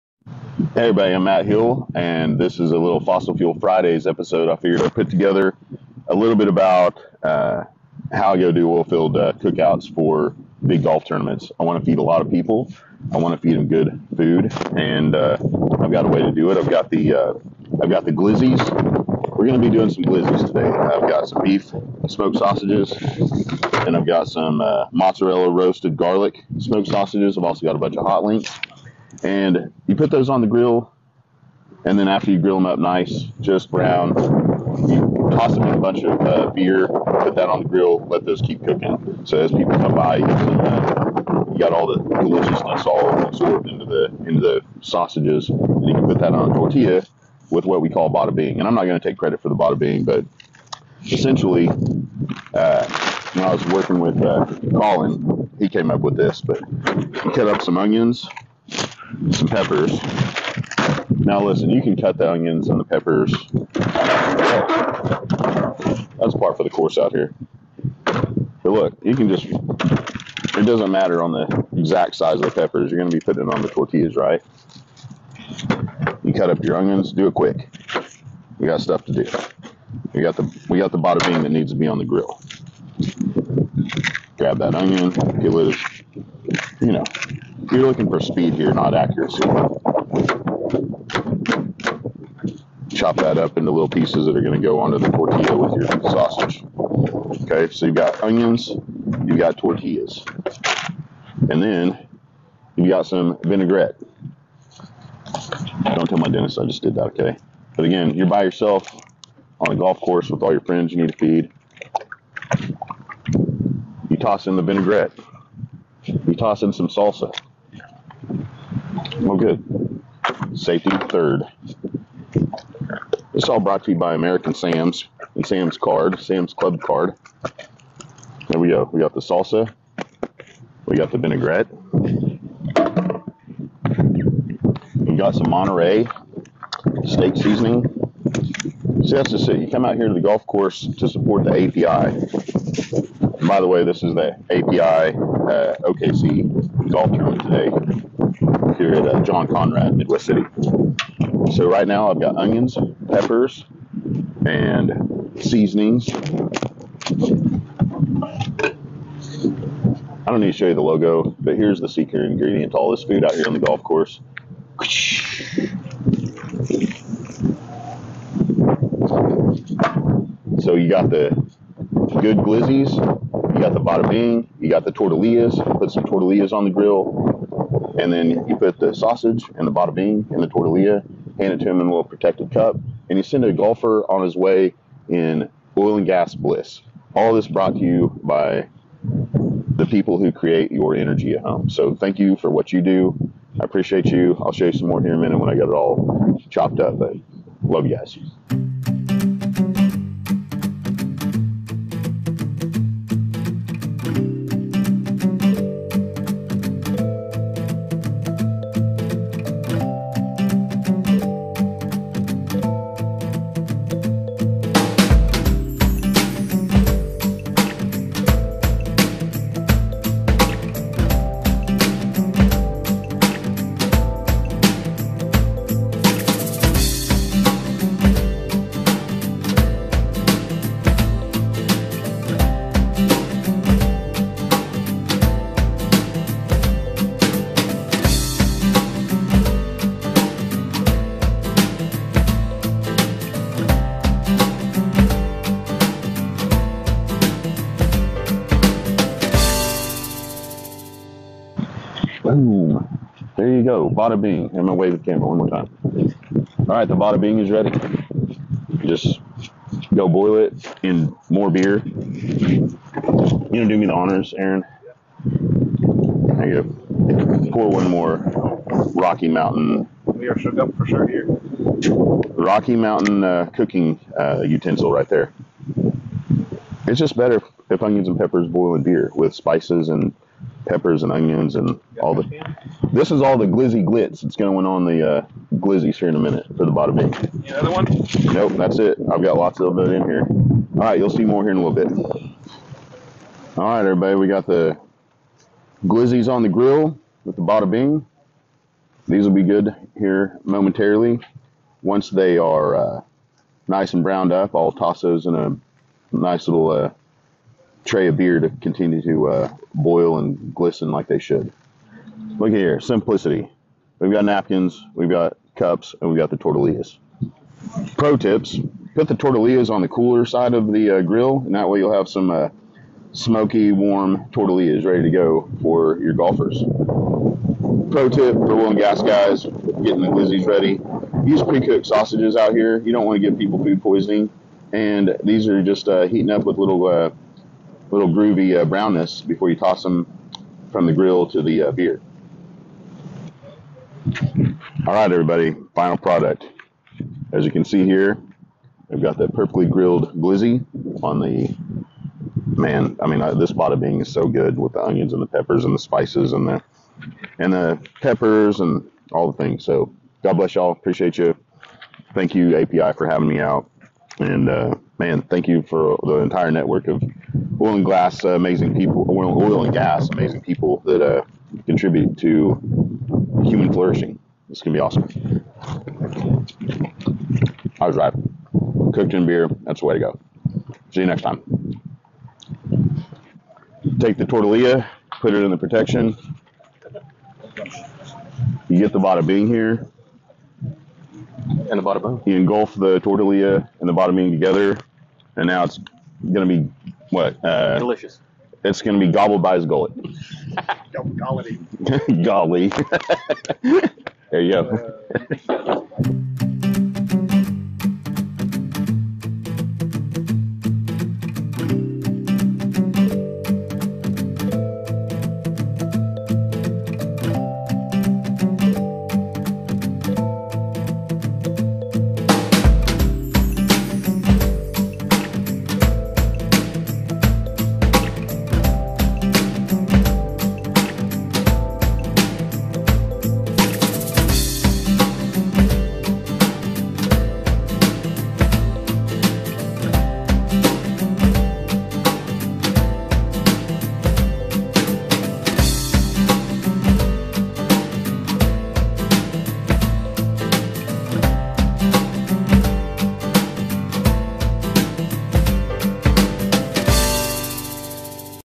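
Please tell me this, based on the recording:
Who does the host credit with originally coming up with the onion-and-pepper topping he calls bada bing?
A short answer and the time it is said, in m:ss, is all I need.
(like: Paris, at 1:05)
Colin, at 0:54.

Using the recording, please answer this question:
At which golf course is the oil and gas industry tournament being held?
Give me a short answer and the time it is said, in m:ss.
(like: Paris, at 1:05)
John Conrad, at 2:29.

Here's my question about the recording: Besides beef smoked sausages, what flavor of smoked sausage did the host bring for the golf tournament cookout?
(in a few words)
Mozzarella roasted garlic.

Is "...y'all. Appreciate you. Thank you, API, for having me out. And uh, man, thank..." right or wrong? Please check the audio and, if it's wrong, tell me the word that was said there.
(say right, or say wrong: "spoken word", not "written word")
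right.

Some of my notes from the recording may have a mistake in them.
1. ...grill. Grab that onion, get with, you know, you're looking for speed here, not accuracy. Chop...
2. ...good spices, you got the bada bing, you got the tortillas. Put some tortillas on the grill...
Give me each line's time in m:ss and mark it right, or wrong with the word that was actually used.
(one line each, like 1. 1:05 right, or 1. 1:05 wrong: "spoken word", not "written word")
1. 1:22 right
2. 2:52 wrong: "glizzies", not "spices".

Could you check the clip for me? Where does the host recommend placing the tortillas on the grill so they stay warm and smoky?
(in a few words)
Cooler side.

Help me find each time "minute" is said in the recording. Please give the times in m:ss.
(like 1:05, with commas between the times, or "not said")
3:15, 4:46.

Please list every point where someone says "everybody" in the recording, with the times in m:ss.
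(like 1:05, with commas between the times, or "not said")
0:00, 4:53, 5:45.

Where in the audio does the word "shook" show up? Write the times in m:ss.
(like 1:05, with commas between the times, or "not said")
4:30.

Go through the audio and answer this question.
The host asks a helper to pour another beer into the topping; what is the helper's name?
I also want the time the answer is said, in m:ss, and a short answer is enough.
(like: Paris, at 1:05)
Aaron, at 4:24.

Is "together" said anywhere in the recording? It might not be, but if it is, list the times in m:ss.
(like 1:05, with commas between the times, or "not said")
0:05, 6:34.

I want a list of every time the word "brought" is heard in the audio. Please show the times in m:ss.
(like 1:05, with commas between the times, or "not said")
2:03, 3:07.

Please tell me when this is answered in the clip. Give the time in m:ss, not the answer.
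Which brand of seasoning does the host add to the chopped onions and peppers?
2:15.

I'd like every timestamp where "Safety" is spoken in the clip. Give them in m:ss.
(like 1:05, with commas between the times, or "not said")
2:00.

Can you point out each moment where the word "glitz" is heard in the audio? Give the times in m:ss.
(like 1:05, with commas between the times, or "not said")
4:43.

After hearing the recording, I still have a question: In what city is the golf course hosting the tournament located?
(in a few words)
Midwest City.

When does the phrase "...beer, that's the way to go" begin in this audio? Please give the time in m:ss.
6:19.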